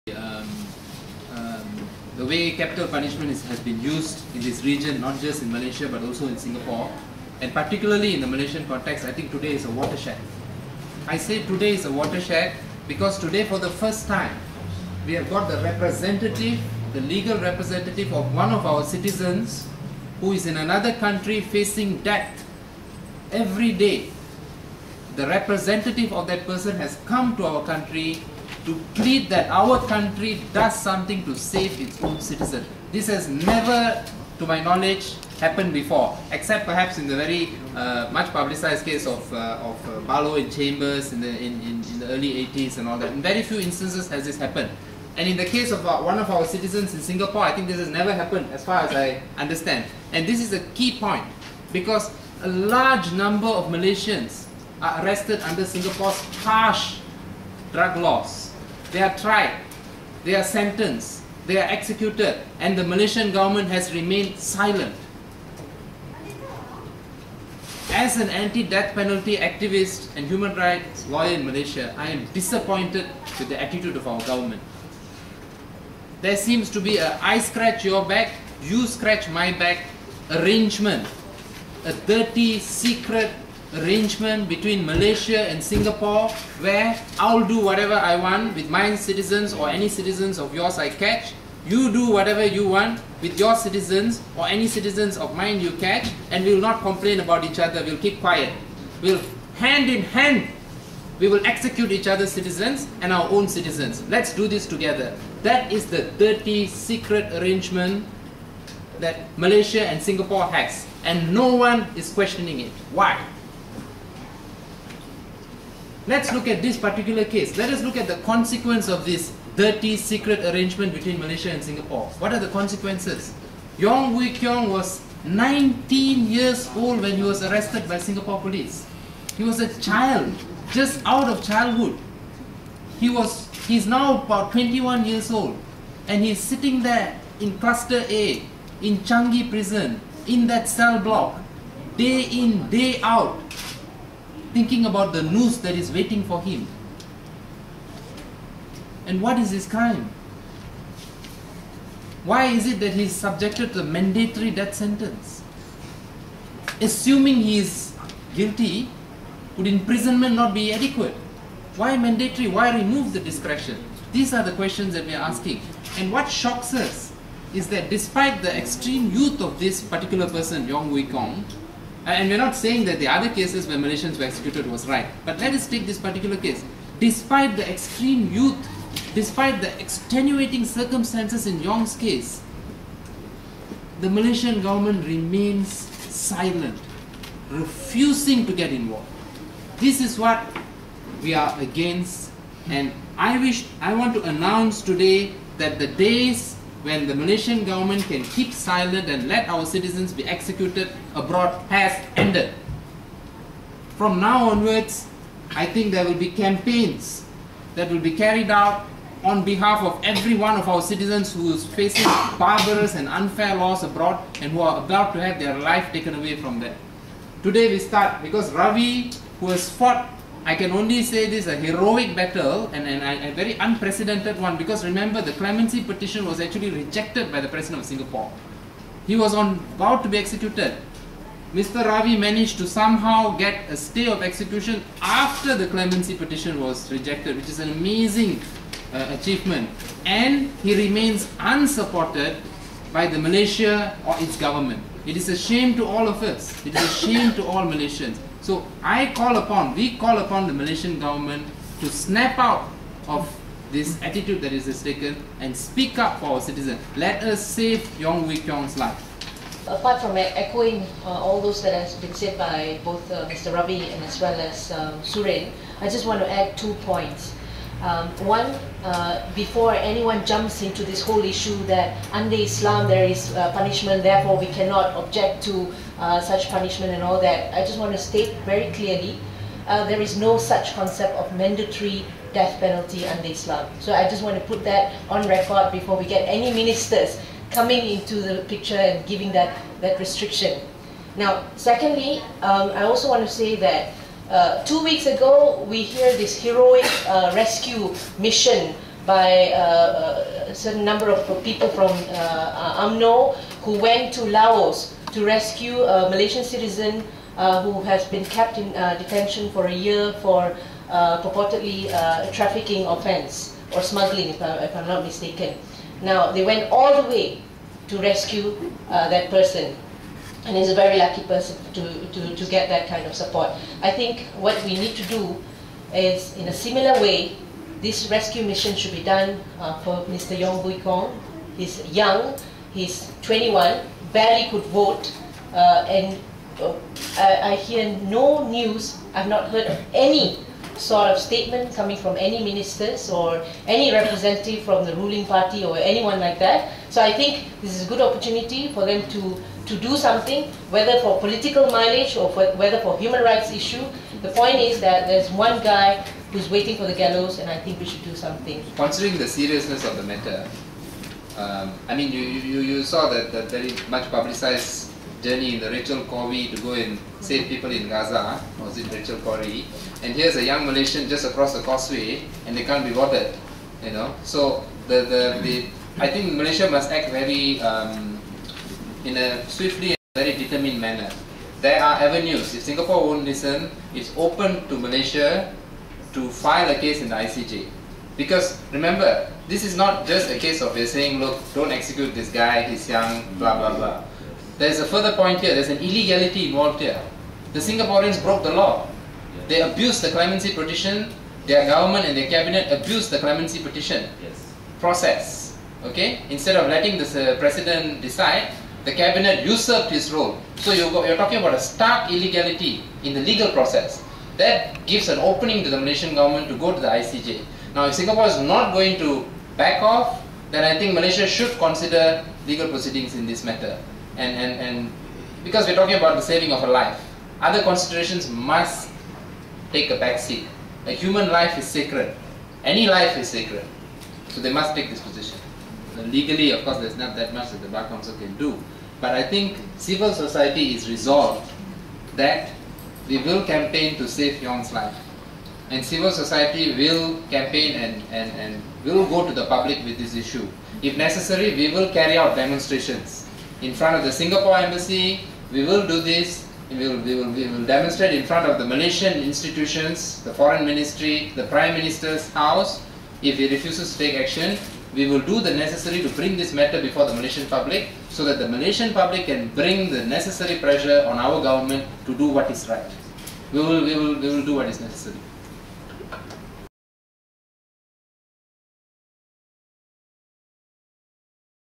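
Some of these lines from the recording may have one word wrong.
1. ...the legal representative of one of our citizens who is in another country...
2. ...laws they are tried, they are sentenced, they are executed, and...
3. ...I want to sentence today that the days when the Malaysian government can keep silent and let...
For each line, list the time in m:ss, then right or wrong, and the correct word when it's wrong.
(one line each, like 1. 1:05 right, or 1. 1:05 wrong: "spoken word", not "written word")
1. 0:16 right
2. 0:57 right
3. 3:13 wrong: "announce", not "sentence".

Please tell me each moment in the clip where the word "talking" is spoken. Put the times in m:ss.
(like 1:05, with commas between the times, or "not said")
6:51, 7:05.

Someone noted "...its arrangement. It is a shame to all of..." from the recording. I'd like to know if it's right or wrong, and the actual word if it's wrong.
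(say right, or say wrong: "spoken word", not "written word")
wrong: "government", not "arrangement".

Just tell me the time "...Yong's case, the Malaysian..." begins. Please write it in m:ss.
3:01.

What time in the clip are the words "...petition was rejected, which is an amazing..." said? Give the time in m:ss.
3:56.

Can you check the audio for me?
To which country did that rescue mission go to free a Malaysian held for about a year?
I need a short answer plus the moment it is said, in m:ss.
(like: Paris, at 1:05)
Laos, at 5:04.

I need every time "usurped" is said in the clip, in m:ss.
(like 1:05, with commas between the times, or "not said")
6:49.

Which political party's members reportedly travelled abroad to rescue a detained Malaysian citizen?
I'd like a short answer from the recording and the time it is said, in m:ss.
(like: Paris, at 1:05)
UMNO, at 5:02.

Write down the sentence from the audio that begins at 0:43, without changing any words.
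In very few instances has this happened.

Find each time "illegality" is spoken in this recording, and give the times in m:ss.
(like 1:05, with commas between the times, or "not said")
6:35, 6:52.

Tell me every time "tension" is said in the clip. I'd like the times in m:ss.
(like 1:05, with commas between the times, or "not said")
not said.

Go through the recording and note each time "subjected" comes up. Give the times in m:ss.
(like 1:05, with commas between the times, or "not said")
2:33.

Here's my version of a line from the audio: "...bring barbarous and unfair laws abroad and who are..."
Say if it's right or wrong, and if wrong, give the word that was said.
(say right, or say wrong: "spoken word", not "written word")
wrong: "facing", not "bring".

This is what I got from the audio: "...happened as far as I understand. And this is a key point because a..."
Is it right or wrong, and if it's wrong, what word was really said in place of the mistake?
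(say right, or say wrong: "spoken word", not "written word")
right.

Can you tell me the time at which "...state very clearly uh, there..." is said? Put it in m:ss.
4:37.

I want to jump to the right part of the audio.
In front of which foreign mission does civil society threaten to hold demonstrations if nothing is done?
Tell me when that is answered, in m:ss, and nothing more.
7:34.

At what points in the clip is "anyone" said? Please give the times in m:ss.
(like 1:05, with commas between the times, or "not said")
4:29, 5:45.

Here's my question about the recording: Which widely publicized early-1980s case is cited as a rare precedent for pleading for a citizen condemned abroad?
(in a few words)
Barlow and Chambers.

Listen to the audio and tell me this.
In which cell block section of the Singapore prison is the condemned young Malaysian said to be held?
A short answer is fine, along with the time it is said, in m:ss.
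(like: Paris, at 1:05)
Cluster A, at 2:17.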